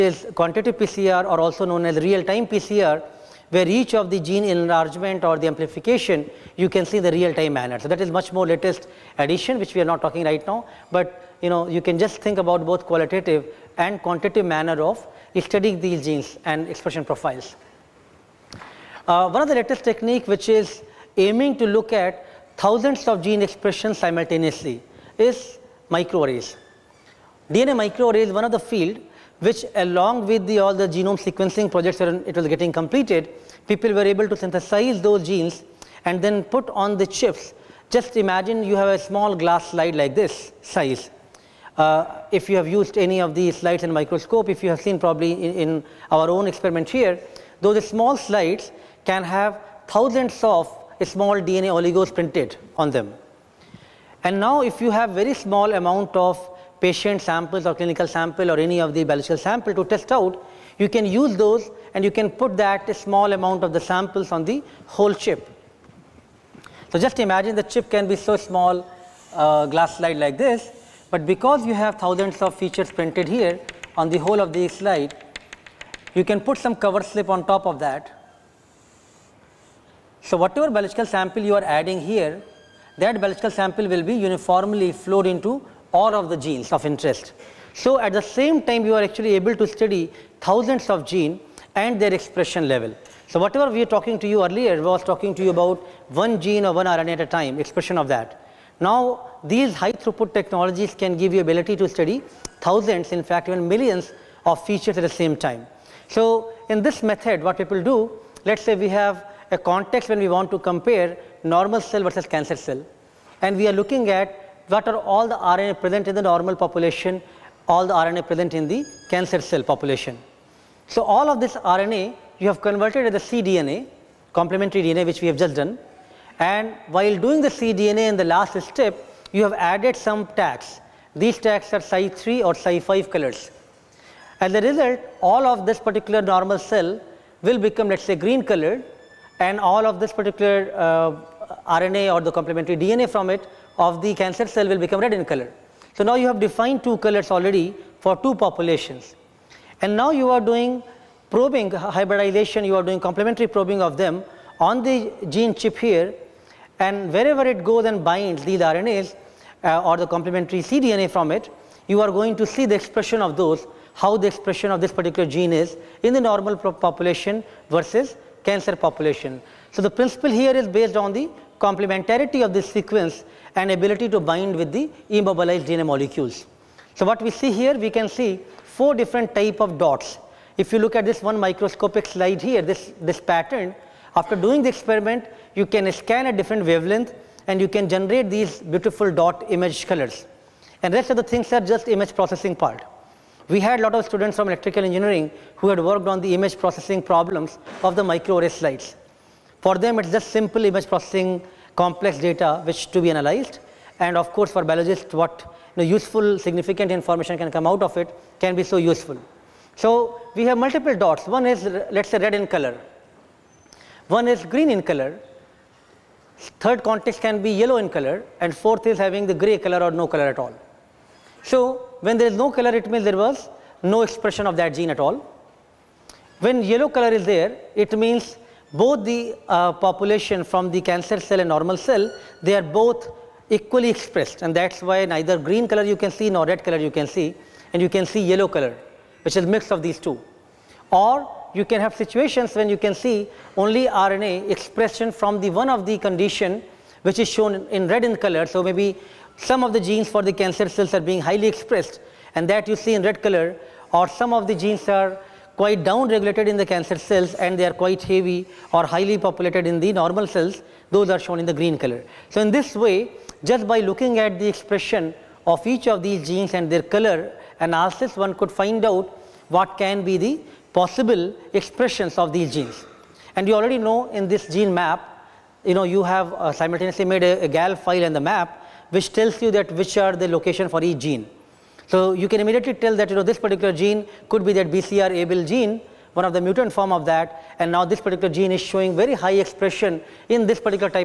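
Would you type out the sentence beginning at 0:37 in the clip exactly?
Just imagine you have a small glass slide like this size.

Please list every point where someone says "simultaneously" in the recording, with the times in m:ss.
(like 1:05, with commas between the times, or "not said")
0:23, 4:36.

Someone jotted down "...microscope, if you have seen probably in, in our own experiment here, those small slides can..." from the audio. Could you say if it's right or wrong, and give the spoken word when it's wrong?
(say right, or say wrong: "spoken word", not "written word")
right.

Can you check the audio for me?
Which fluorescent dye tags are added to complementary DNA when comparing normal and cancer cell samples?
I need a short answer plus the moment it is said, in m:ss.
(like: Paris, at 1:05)
Cy3 or Cy5, at 2:11.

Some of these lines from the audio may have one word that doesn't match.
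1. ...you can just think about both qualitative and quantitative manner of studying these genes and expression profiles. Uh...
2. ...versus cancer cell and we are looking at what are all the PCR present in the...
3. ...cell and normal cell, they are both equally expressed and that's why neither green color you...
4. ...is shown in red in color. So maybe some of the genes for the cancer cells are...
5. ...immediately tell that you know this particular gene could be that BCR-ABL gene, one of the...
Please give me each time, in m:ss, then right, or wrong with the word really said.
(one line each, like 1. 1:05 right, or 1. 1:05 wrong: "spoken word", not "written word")
1. 0:11 right
2. 1:52 wrong: "RNA", not "PCR"
3. 3:51 right
4. 4:07 right
5. 4:42 right.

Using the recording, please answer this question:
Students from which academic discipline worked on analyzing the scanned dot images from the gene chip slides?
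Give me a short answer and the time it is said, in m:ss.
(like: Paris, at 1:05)
Electrical engineering, at 3:14.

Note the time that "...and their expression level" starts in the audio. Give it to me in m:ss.
1:31.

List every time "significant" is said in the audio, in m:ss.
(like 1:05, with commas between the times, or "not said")
3:26.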